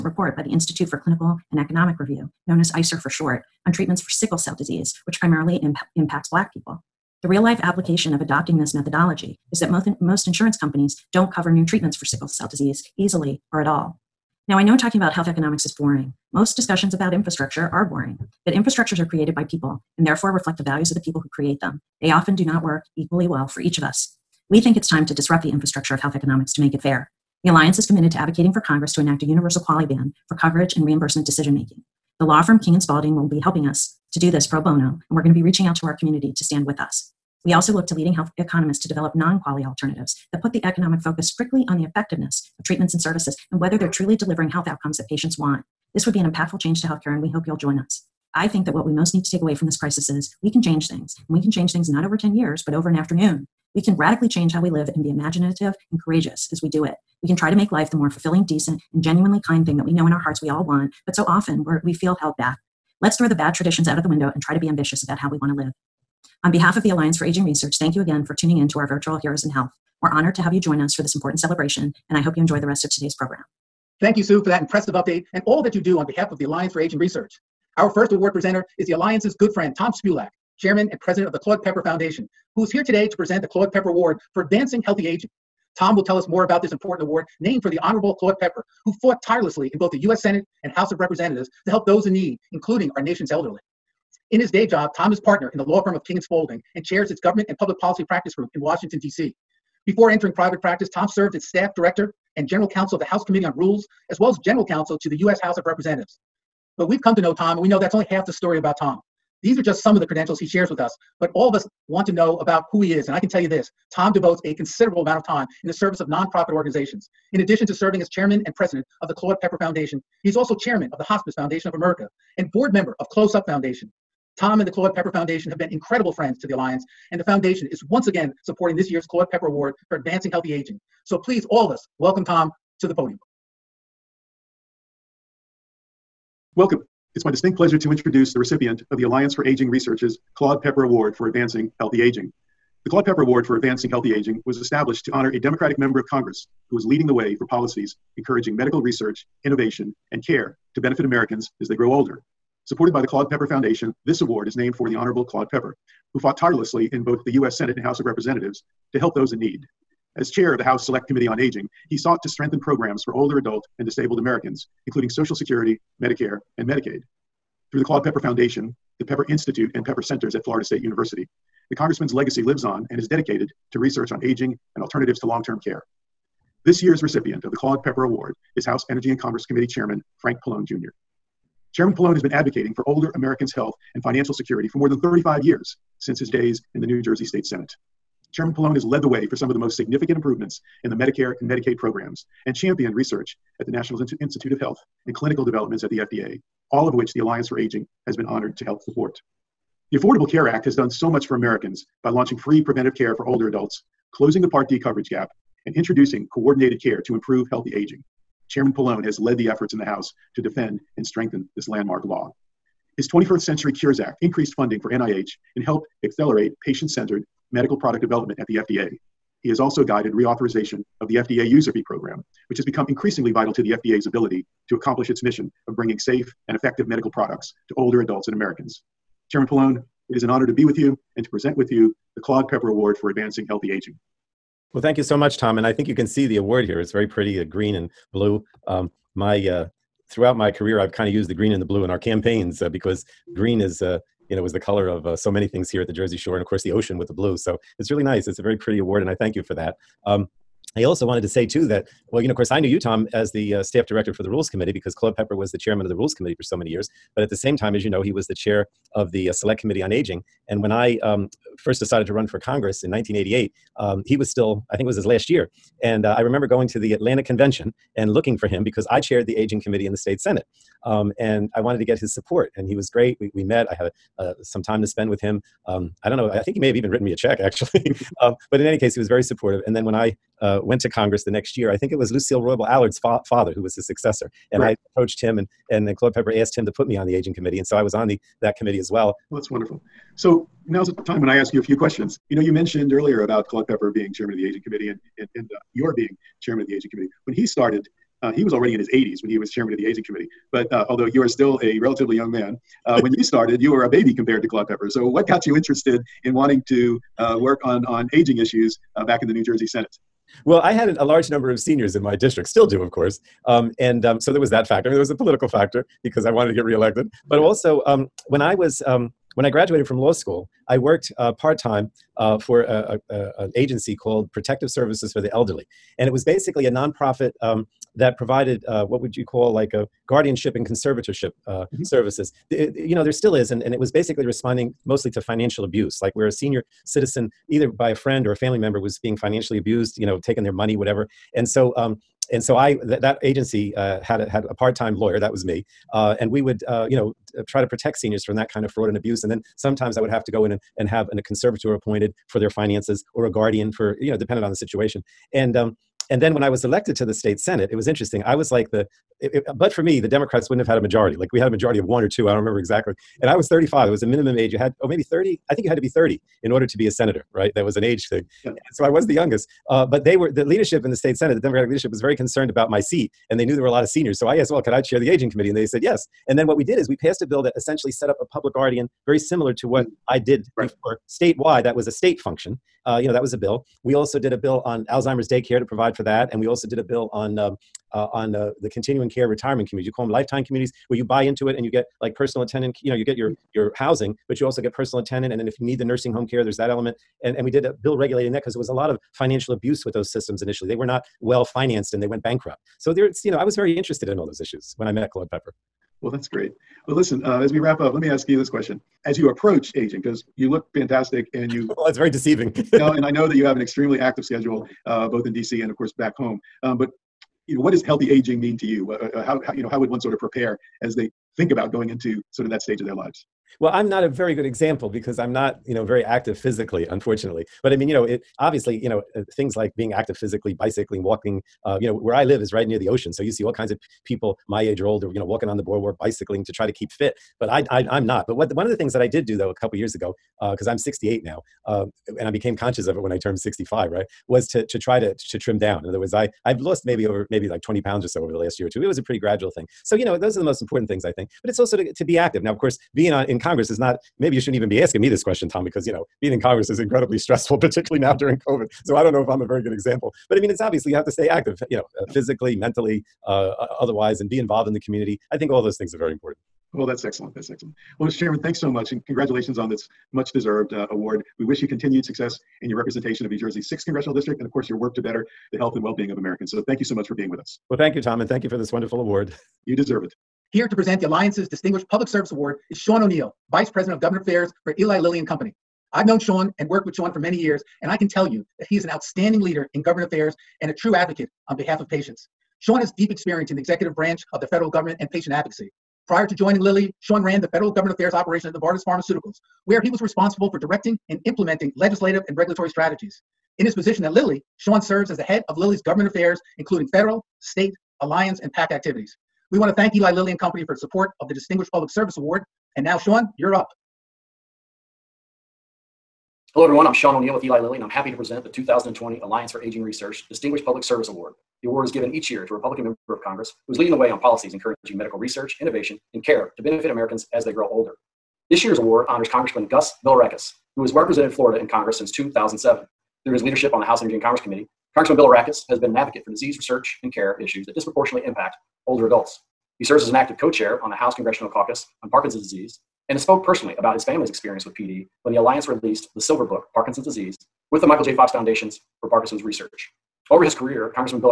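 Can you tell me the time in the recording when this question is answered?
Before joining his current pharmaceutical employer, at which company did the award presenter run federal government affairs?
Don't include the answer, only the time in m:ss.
8:18.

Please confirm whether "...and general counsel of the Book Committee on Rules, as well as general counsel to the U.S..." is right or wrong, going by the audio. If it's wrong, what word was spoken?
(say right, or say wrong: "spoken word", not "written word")
wrong: "House", not "Book".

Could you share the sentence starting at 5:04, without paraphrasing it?
So, what got you interested in wanting to uh, work on, on aging issues uh, back in the New Jersey Senate?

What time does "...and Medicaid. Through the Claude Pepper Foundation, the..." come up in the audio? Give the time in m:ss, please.
2:46.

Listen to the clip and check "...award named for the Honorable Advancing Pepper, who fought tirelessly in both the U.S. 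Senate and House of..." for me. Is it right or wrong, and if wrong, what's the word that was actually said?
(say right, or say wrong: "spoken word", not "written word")
wrong: "Claude", not "Advancing".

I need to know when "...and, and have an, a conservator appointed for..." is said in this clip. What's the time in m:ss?
5:50.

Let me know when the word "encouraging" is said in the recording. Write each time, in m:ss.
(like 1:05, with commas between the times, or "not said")
2:28, 8:44.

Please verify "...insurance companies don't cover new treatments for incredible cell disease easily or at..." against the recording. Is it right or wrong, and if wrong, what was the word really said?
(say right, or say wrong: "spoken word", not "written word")
wrong: "sickle", not "incredible".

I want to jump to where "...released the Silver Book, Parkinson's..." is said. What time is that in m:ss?
9:05.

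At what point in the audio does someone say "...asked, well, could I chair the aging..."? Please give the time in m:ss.
6:14.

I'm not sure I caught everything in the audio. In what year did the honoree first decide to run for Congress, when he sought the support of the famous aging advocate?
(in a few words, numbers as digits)
1988.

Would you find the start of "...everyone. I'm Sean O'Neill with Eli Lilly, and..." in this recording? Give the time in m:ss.
8:36.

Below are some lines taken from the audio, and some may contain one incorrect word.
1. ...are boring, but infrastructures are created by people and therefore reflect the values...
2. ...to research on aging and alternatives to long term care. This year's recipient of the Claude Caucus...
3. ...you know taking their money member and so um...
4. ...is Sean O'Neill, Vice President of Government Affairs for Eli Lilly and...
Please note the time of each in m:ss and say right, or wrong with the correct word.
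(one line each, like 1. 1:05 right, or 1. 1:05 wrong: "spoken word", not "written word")
1. 0:17 right
2. 2:53 wrong: "Pepper", not "Caucus"
3. 5:39 wrong: "whatever", not "member"
4. 8:02 right.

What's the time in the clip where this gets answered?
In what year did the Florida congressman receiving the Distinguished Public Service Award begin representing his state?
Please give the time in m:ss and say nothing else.
8:52.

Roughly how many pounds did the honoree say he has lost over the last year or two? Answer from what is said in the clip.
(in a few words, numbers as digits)
20.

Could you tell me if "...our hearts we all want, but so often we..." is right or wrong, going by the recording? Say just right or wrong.
right.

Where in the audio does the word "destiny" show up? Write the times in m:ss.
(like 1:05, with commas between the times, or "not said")
not said.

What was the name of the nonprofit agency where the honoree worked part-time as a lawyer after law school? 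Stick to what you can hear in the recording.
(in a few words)
Protective Services for the Elderly.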